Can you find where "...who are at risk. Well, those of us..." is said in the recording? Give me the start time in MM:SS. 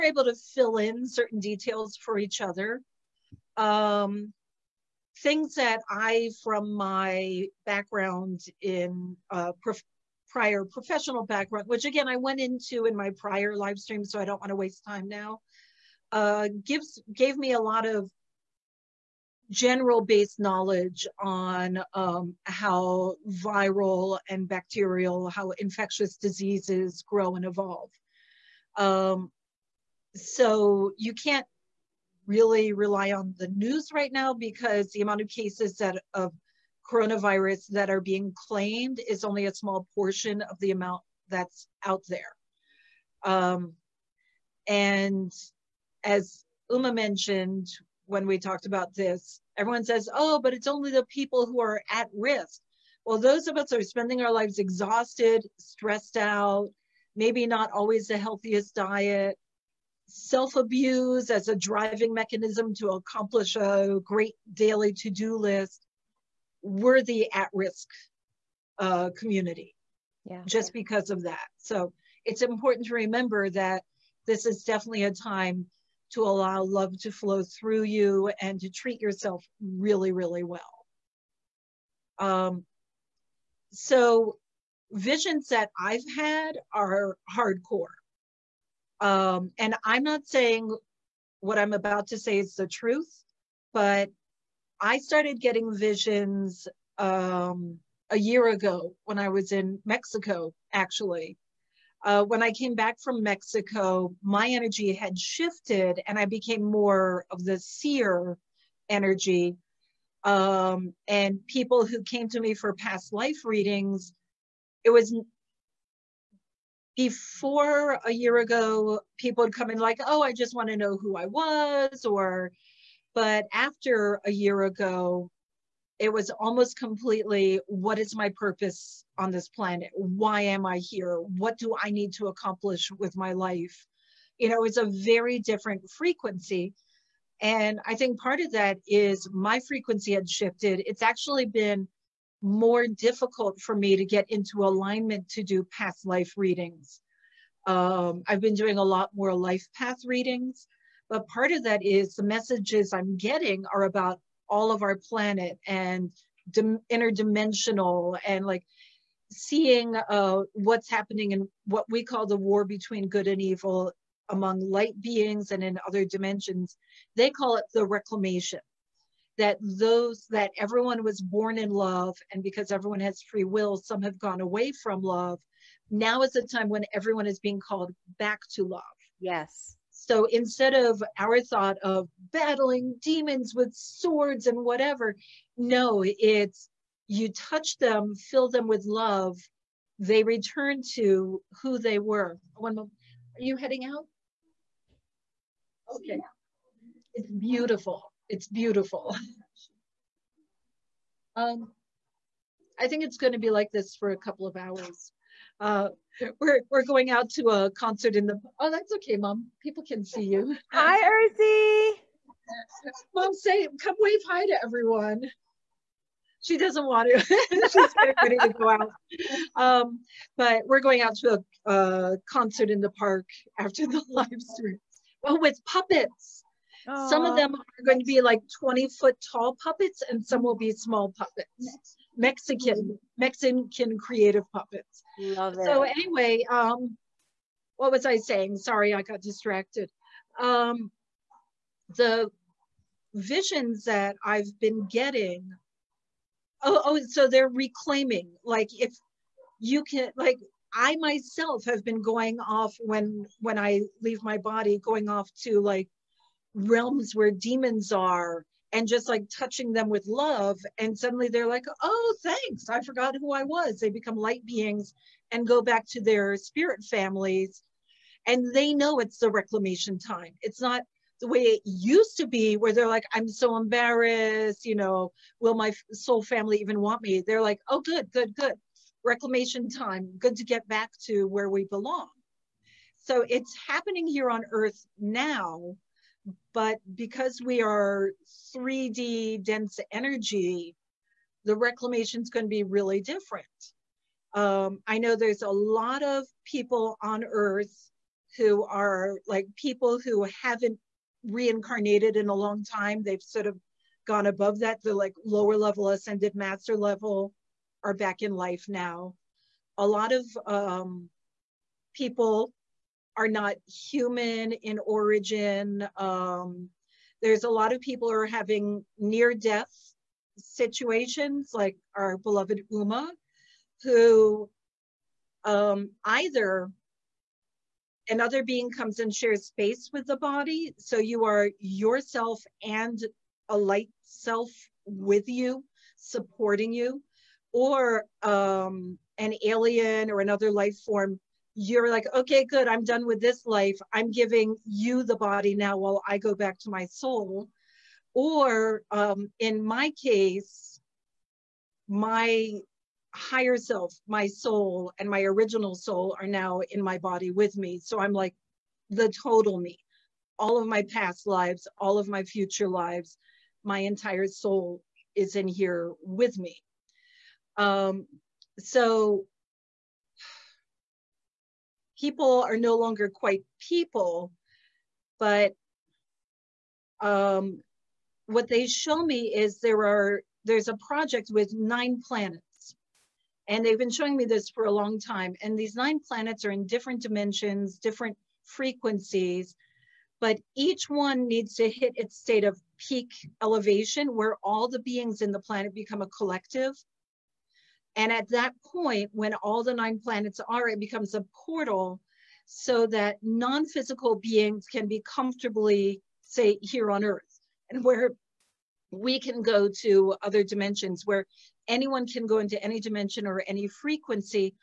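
00:51.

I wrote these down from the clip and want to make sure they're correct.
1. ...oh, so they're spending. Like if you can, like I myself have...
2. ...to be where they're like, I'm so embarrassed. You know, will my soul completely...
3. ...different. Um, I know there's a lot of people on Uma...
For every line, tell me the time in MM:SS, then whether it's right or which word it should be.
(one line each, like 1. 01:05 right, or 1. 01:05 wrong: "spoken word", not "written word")
1. 04:06 wrong: "reclaiming", not "spending"
2. 04:32 wrong: "family", not "completely"
3. 04:53 wrong: "Earth", not "Uma".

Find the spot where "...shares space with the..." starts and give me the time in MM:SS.
05:29.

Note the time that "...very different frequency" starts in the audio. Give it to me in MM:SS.
02:14.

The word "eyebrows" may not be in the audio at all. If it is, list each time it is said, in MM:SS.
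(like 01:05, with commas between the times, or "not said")
not said.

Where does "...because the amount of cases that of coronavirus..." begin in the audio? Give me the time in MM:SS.
00:34.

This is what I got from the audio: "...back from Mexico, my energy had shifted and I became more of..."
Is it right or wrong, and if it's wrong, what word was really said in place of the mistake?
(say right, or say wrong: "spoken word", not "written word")
right.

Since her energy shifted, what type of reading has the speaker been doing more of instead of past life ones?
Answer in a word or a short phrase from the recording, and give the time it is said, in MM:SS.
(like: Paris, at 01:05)
life path readings, at 02:29.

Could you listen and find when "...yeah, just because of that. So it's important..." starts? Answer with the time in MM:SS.
01:10.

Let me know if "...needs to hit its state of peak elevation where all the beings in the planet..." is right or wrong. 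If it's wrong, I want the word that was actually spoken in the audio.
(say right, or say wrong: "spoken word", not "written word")
right.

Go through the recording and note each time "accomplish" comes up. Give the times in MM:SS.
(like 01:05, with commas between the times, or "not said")
01:02, 02:12.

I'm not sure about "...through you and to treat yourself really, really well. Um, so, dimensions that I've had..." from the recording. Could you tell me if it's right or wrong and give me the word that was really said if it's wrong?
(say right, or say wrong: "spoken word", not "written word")
wrong: "visions", not "dimensions".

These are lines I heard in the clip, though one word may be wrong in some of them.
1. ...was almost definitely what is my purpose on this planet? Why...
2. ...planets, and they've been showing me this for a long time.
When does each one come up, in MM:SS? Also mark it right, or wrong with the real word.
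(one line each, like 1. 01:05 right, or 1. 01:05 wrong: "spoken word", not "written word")
1. 02:06 wrong: "completely", not "definitely"
2. 06:22 right.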